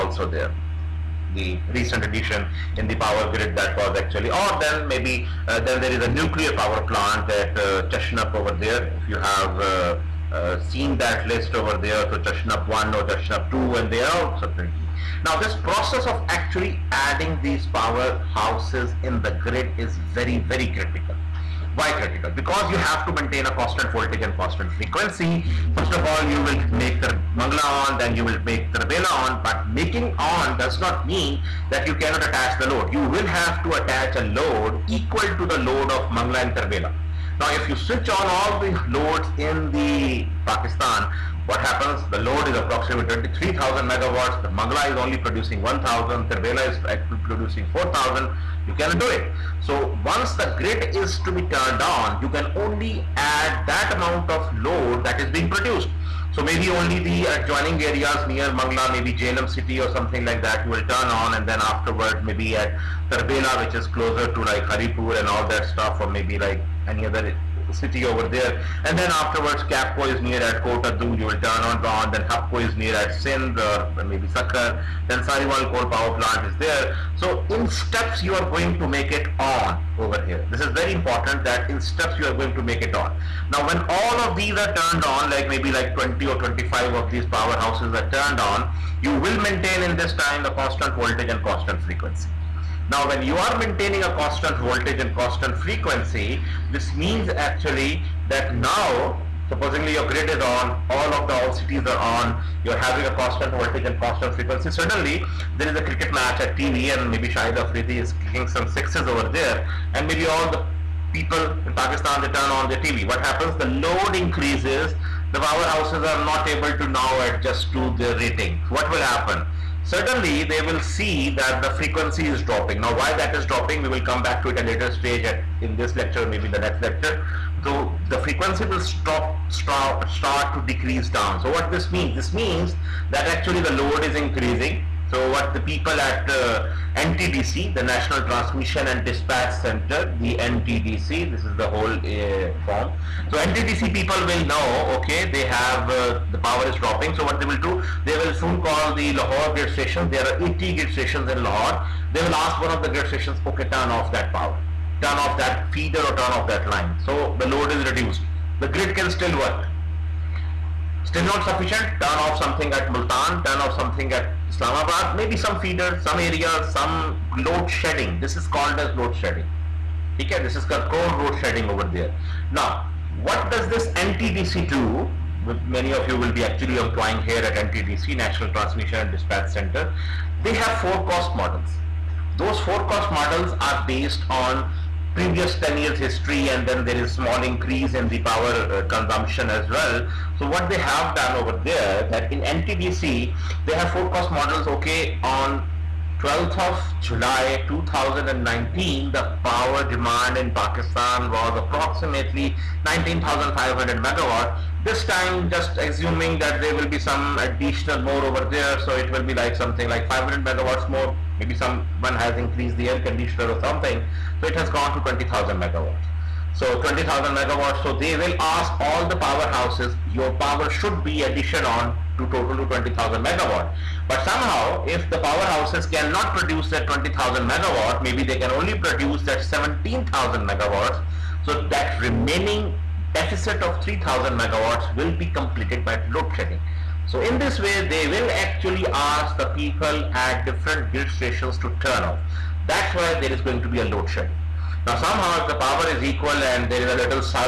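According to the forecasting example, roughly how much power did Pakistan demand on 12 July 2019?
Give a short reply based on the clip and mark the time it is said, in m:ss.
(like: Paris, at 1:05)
19,500 megawatts, at 3:22.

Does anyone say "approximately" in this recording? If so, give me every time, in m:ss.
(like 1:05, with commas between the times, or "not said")
0:42, 3:21.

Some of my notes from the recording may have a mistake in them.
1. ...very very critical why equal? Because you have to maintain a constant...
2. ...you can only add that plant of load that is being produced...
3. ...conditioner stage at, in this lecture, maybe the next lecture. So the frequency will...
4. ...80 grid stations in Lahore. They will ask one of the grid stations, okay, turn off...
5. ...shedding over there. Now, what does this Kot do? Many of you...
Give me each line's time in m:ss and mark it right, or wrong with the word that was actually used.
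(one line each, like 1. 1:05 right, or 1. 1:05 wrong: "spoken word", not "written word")
1. 0:20 wrong: "critical", not "equal"
2. 0:52 wrong: "amount", not "plant"
3. 2:04 wrong: "later", not "conditioner"
4. 2:30 right
5. 2:51 wrong: "NTDC", not "Kot".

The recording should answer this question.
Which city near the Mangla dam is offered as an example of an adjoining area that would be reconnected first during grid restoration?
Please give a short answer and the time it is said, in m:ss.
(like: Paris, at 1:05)
Jhelum, at 0:59.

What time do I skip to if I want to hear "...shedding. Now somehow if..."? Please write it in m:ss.
4:04.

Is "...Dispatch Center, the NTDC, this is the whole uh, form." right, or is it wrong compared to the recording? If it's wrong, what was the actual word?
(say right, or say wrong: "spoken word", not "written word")
right.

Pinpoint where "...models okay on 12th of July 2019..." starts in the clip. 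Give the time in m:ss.
3:14.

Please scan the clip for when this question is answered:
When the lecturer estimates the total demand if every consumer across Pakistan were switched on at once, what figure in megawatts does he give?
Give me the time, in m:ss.
0:43.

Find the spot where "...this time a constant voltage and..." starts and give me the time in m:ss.
1:29.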